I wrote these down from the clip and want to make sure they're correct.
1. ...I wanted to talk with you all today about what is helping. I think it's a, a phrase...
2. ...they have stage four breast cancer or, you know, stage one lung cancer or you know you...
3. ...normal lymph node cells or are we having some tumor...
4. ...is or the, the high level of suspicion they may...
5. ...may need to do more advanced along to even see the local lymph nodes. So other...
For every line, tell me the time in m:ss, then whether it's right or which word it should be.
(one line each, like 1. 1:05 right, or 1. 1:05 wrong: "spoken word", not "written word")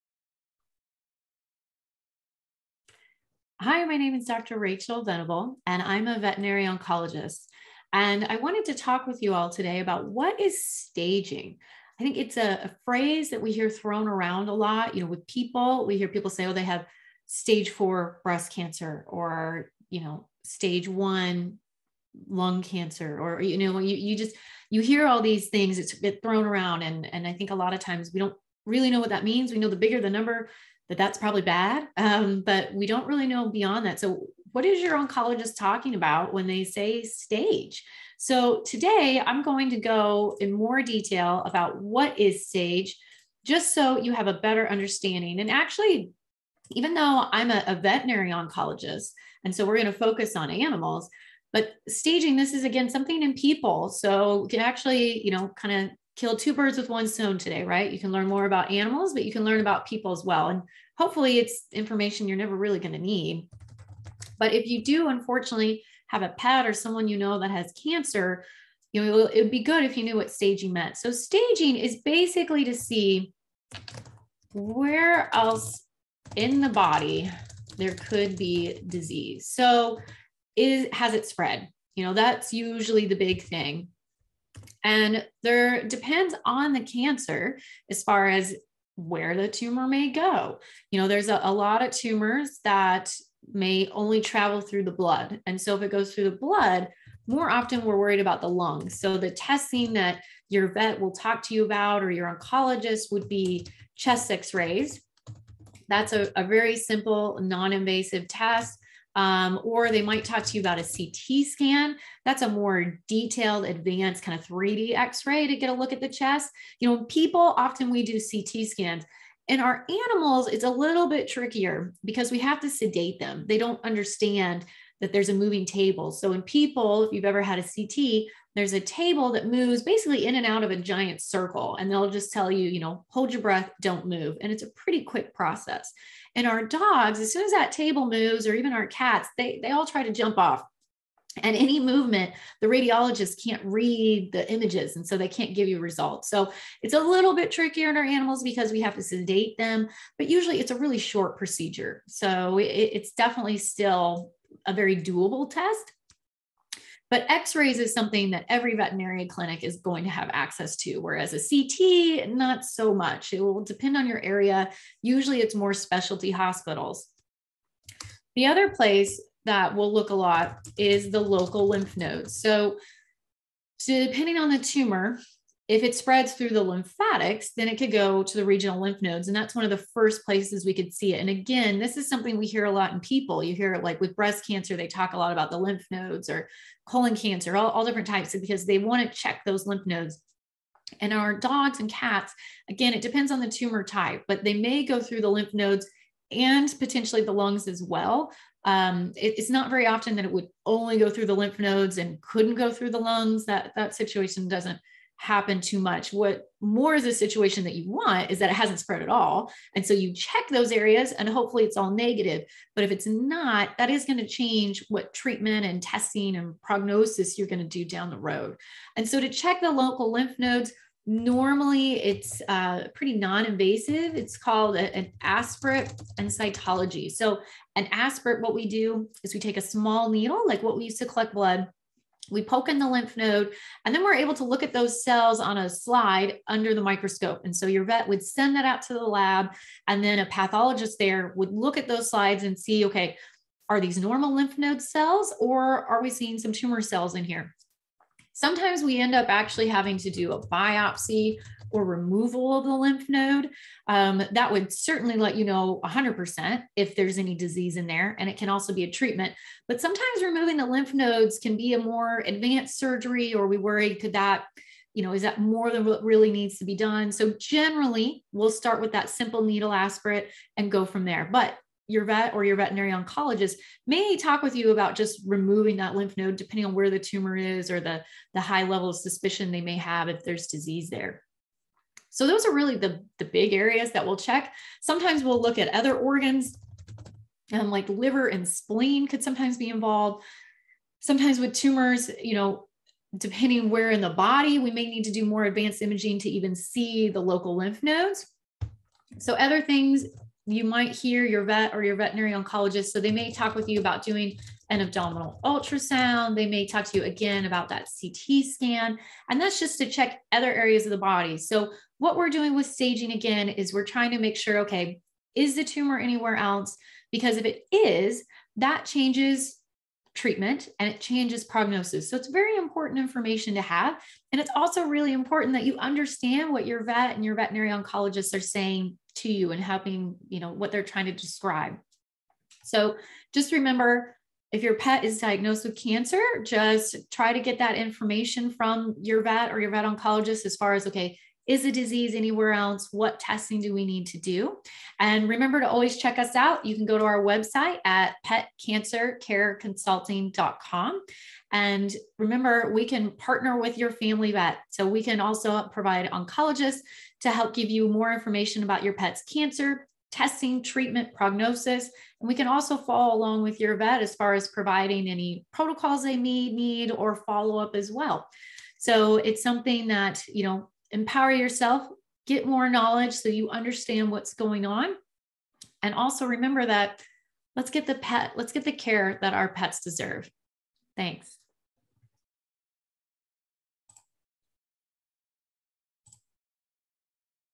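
1. 0:08 wrong: "staging", not "helping"
2. 0:16 right
3. 4:03 wrong: "seeing", not "having"
4. 4:37 right
5. 4:54 wrong: "imaging", not "along".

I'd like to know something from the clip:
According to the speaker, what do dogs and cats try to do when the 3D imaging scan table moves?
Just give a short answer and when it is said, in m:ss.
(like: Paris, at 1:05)
Jump off, at 2:20.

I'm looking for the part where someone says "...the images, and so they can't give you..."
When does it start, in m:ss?
2:24.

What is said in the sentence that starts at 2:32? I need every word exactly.
So it, it's definitely still a very doable test.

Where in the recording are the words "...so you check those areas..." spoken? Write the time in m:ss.
3:29.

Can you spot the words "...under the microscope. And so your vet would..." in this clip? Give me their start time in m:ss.
3:56.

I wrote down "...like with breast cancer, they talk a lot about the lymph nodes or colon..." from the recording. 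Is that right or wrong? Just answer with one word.
right.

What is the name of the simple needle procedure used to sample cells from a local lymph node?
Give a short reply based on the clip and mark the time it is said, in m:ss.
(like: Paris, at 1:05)
Aspirate and cytology, at 3:45.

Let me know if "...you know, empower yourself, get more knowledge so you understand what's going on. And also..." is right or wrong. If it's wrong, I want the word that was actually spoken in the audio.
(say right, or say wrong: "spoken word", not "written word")
right.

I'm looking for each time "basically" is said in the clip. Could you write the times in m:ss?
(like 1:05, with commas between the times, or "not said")
1:12, 2:09.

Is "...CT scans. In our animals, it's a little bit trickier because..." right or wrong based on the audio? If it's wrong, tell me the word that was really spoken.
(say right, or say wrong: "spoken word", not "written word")
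right.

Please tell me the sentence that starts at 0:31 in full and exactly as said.
Um, but we don't really know beyond that.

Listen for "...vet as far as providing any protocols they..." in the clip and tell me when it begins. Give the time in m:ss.
6:03.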